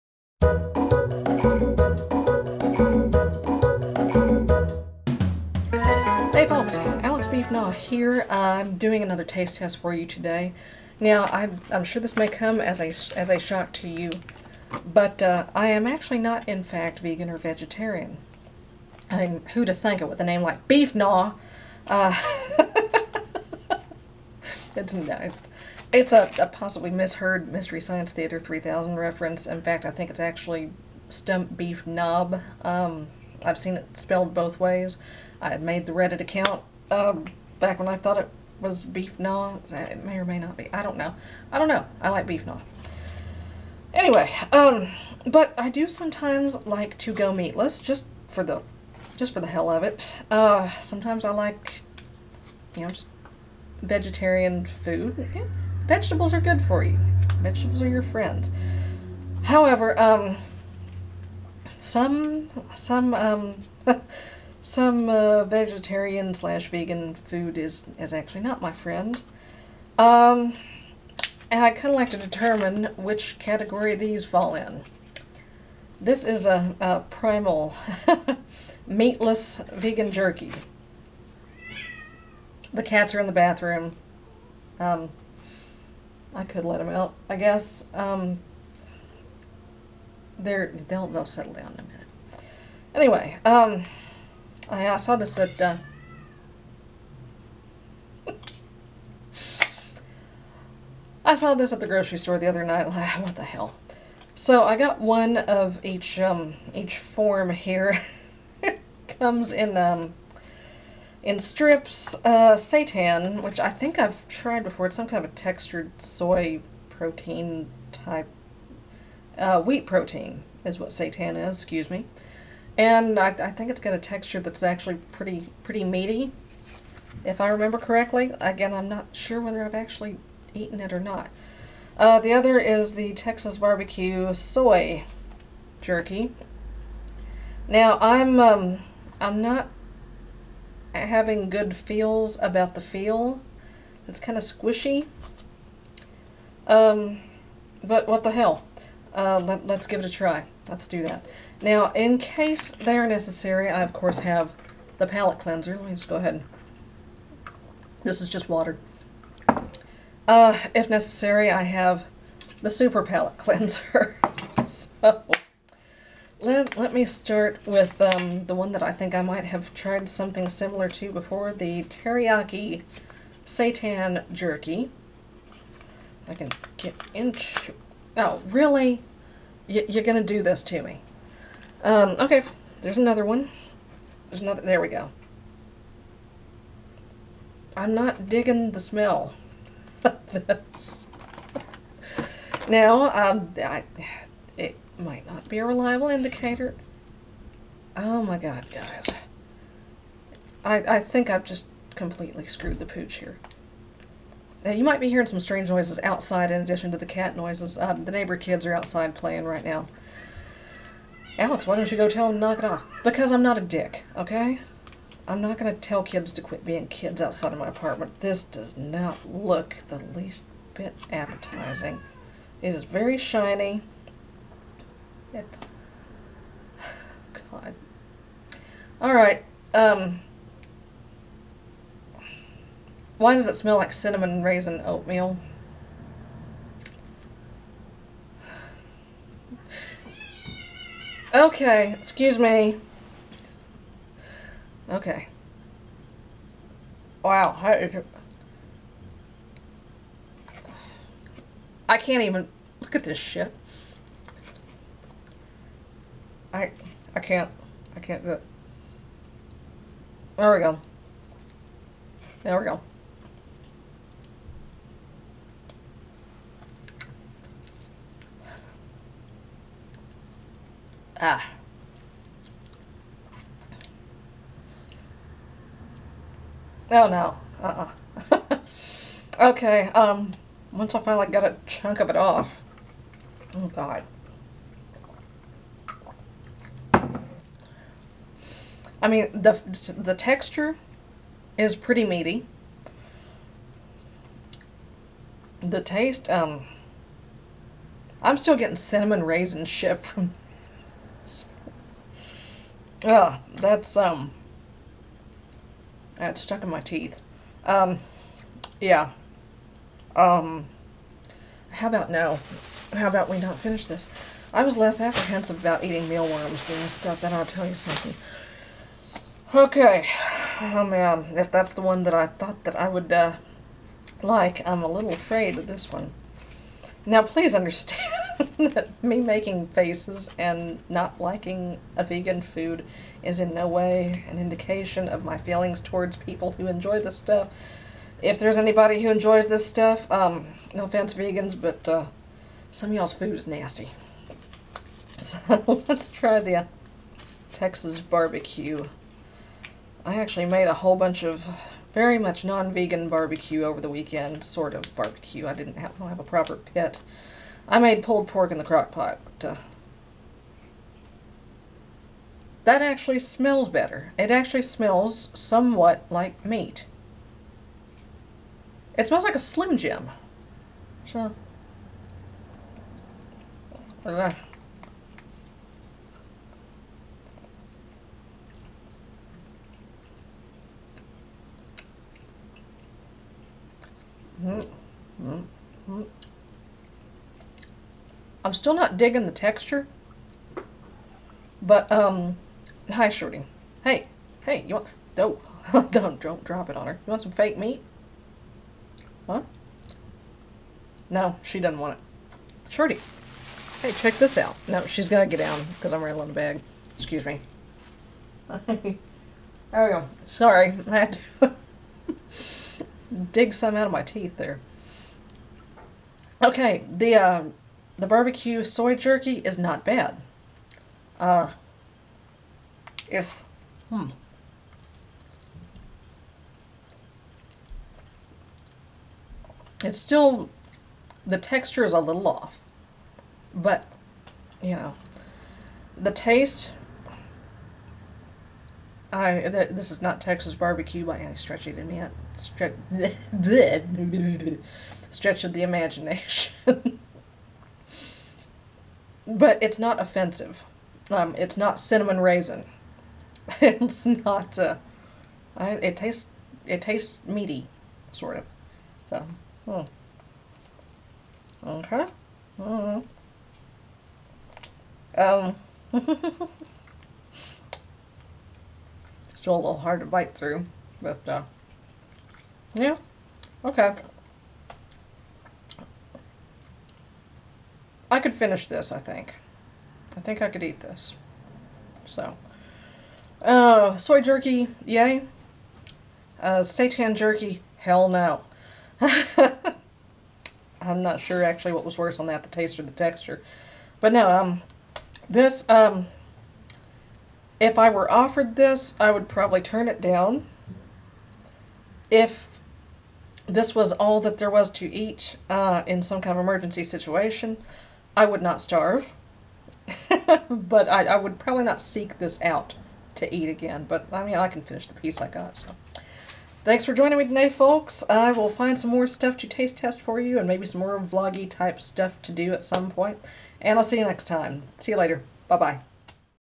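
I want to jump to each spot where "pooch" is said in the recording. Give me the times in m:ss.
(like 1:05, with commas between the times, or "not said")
3:22.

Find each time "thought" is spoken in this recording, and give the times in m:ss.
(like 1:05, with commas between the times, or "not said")
0:37, 5:22.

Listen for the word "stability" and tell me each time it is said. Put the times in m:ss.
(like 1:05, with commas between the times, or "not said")
not said.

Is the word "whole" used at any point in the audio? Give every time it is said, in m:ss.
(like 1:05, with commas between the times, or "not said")
5:50.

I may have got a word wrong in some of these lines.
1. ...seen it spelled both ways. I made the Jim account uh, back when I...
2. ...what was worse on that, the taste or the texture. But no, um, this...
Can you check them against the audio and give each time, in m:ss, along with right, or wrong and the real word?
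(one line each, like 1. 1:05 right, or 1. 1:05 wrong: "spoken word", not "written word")
1. 0:33 wrong: "Reddit", not "Jim"
2. 8:11 right.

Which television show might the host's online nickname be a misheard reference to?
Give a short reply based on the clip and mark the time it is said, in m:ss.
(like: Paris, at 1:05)
Mystery Science Theater 3000, at 0:27.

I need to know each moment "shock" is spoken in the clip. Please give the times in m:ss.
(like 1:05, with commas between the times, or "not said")
0:13.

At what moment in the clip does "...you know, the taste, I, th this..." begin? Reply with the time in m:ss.
7:14.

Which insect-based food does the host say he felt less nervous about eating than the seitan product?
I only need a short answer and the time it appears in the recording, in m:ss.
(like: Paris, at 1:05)
mealworms, at 5:16.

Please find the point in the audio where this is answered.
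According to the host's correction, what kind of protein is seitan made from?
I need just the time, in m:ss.
1:59.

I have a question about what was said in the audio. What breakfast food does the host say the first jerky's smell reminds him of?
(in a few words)
cinnamon raisin oatmeal.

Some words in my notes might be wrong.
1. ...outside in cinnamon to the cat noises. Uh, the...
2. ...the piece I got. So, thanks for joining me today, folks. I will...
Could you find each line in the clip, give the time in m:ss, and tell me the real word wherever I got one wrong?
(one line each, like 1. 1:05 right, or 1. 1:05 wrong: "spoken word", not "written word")
1. 3:26 wrong: "addition", not "cinnamon"
2. 8:34 right.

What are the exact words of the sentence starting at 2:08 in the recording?
Again, I'm not sure whether I've actually eaten it or not.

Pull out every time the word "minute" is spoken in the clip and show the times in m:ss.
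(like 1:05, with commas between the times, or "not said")
1:31.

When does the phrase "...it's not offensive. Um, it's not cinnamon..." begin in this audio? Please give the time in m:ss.
7:29.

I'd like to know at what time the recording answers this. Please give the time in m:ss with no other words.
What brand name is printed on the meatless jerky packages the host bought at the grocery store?
1:17.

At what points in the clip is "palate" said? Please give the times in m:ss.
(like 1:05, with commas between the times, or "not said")
2:35, 2:43.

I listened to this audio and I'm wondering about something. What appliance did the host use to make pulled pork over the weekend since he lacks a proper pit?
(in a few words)
crock pot.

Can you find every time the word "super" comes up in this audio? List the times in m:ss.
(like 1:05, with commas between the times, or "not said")
2:42.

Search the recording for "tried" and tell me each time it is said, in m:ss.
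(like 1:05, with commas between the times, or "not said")
1:54, 2:49.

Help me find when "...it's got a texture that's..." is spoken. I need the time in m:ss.
2:03.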